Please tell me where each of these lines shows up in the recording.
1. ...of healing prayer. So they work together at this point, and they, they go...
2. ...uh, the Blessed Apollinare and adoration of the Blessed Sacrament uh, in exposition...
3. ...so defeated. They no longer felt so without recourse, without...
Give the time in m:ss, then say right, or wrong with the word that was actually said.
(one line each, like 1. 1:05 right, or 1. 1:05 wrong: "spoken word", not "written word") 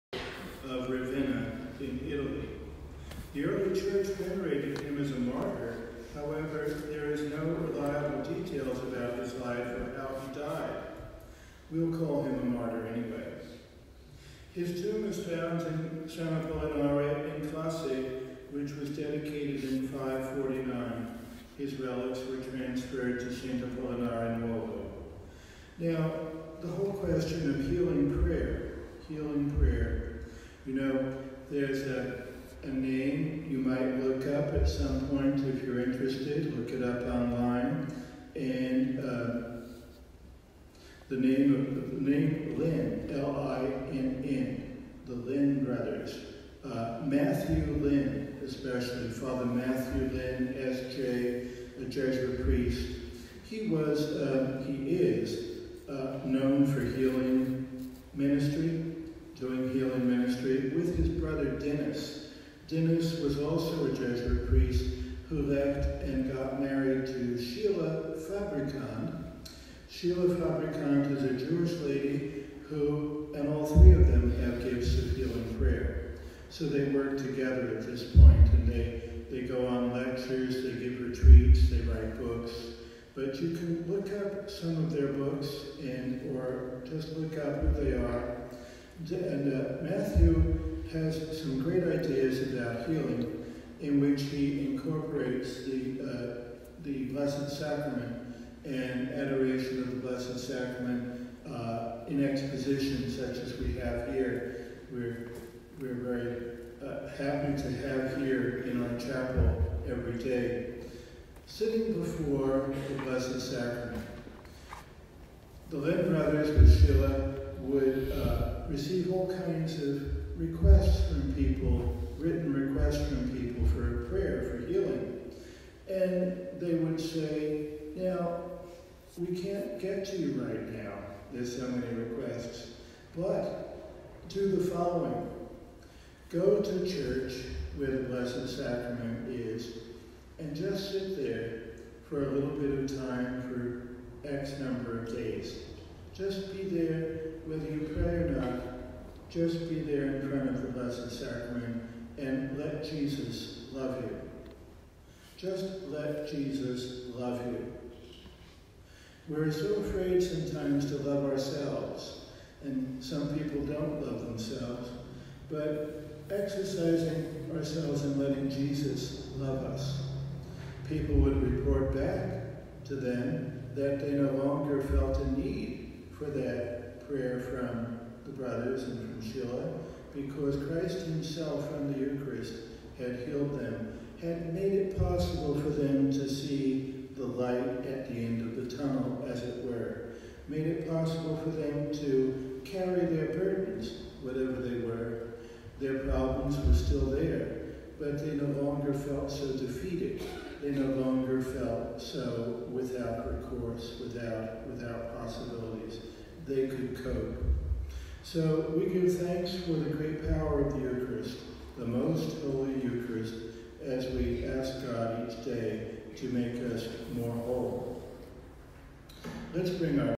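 1. 1:14 right
2. 1:36 wrong: "Sacrament", not "Apollinare"
3. 3:19 right.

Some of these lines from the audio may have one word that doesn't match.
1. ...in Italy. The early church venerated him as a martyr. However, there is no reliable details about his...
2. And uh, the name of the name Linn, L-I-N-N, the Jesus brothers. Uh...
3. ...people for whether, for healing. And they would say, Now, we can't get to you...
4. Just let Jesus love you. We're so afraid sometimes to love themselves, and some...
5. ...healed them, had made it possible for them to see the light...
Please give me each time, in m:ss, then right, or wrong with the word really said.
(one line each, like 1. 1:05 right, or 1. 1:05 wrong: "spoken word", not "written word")
1. 0:01 right
2. 0:38 wrong: "Linn", not "Jesus"
3. 2:03 wrong: "prayer", not "whether"
4. 2:35 wrong: "ourselves", not "themselves"
5. 3:03 right.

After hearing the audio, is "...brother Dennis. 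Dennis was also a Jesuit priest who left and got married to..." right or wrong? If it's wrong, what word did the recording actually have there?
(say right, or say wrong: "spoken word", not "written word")
right.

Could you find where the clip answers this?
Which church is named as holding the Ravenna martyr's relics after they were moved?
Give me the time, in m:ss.
0:23.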